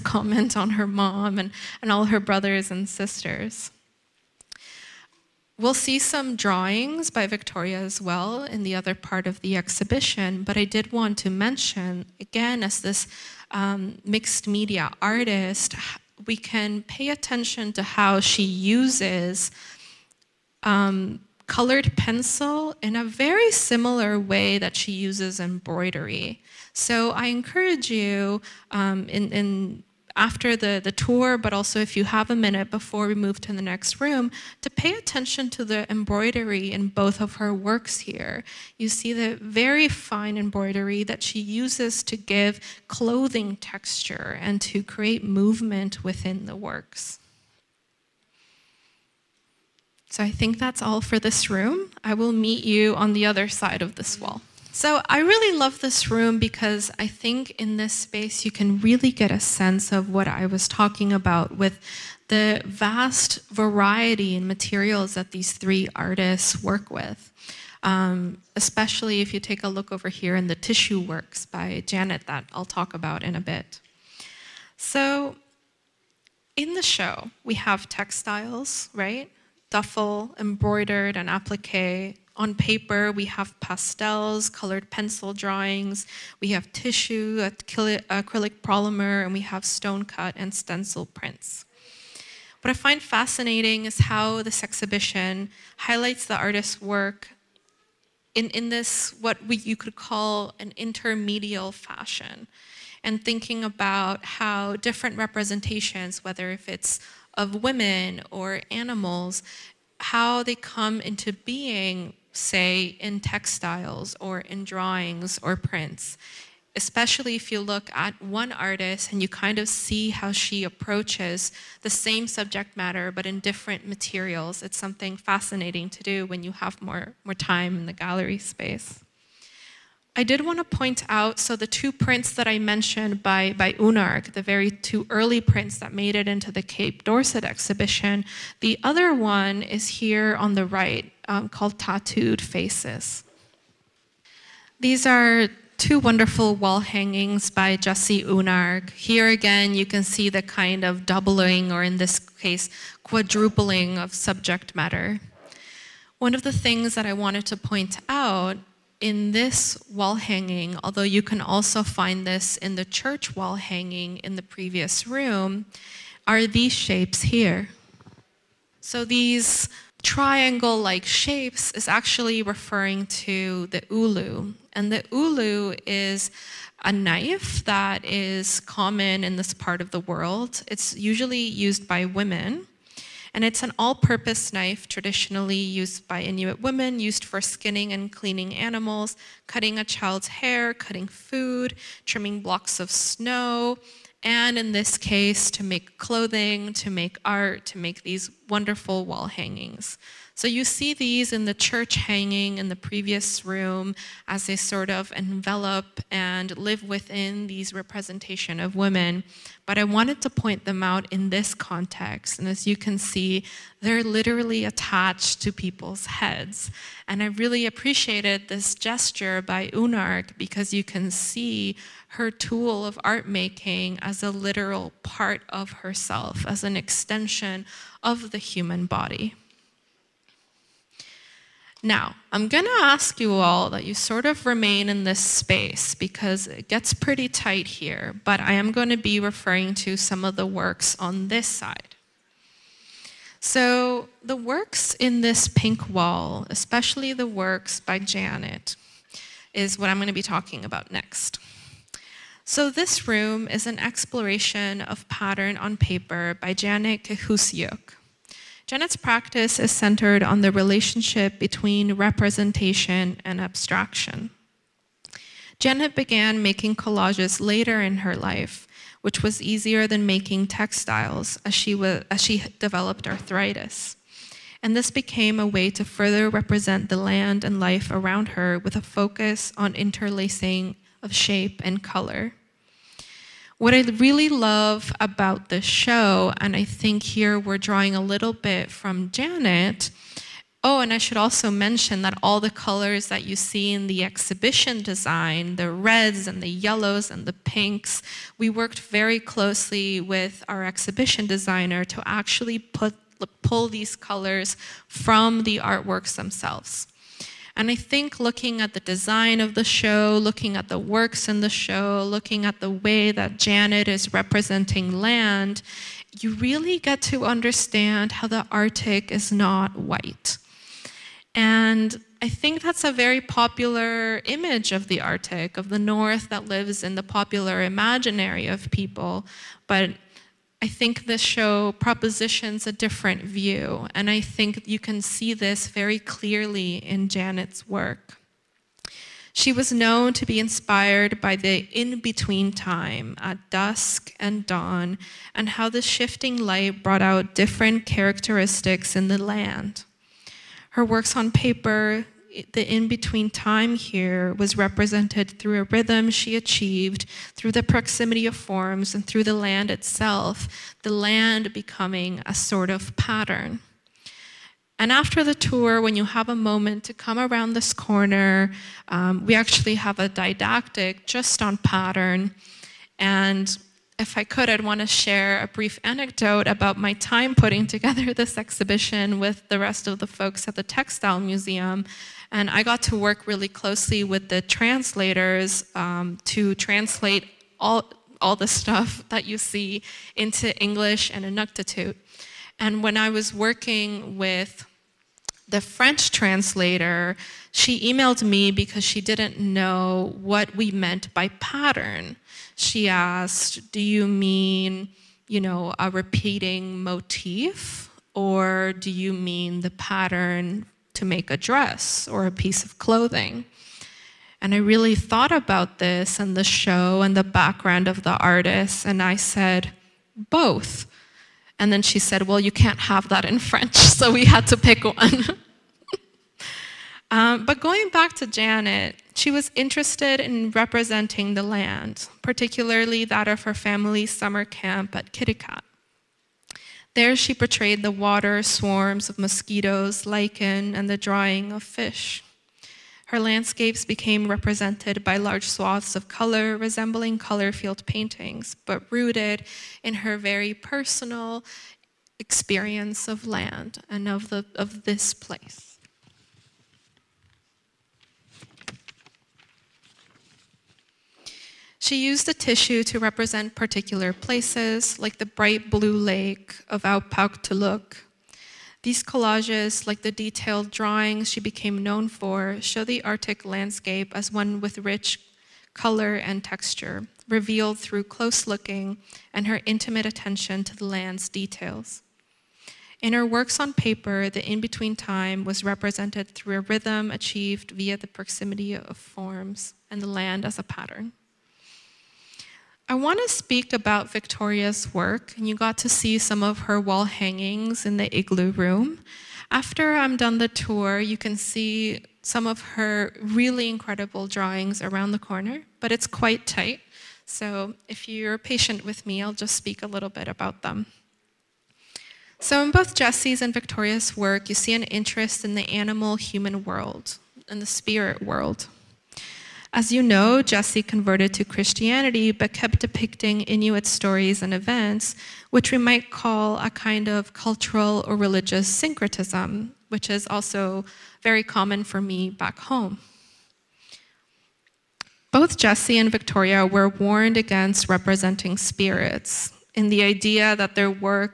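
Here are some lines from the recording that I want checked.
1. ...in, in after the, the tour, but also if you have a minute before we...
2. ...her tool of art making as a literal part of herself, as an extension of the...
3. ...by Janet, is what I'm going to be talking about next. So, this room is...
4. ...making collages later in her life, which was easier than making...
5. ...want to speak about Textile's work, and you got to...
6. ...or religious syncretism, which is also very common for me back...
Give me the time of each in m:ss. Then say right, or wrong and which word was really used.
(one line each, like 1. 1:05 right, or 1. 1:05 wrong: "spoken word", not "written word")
1. 0:29 right
2. 3:42 right
3. 4:07 right
4. 4:26 right
5. 8:12 wrong: "Victoria", not "Textile"
6. 8:48 right.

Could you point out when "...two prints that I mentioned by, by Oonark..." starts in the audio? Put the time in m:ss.
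2:11.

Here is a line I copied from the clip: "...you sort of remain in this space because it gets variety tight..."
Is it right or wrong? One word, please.
wrong.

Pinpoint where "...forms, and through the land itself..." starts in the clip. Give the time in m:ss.
5:58.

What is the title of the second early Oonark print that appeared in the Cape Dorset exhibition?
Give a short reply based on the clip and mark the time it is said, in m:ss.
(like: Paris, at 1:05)
Tattooed Faces, at 2:21.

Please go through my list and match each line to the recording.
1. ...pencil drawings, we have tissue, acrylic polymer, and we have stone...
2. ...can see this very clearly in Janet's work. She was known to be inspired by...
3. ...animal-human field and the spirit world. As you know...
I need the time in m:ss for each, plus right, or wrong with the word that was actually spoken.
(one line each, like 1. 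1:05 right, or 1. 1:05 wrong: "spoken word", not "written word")
1. 1:24 right
2. 5:34 right
3. 8:35 wrong: "world", not "field".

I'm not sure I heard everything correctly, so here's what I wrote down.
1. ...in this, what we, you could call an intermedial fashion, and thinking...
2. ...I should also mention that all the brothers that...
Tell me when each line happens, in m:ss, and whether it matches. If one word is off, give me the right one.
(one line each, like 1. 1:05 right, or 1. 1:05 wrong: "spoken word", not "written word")
1. 1:38 right
2. 4:50 wrong: "colors", not "brothers".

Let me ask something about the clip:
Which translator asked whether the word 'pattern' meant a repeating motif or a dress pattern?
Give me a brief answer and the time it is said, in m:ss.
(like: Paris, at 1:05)
The French translator, at 6:35.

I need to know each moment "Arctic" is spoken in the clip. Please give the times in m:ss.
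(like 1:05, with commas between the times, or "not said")
5:18, 5:25, 7:53.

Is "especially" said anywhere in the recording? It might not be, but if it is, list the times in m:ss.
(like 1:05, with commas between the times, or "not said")
1:08, 1:56, 4:06.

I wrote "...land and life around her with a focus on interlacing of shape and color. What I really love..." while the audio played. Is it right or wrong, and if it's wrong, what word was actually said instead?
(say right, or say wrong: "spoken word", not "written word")
right.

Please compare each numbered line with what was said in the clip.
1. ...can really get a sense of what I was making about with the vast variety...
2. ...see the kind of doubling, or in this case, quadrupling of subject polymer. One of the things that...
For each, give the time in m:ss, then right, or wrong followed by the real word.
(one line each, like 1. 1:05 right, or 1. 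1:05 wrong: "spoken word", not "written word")
1. 0:58 wrong: "talking", not "making"
2. 2:30 wrong: "matter", not "polymer".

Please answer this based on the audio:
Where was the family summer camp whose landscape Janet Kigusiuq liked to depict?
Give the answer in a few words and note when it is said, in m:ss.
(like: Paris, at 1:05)
Kitticut, at 7:15.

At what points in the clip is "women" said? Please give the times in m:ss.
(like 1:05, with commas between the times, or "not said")
1:47, 3:02, 3:06, 3:28.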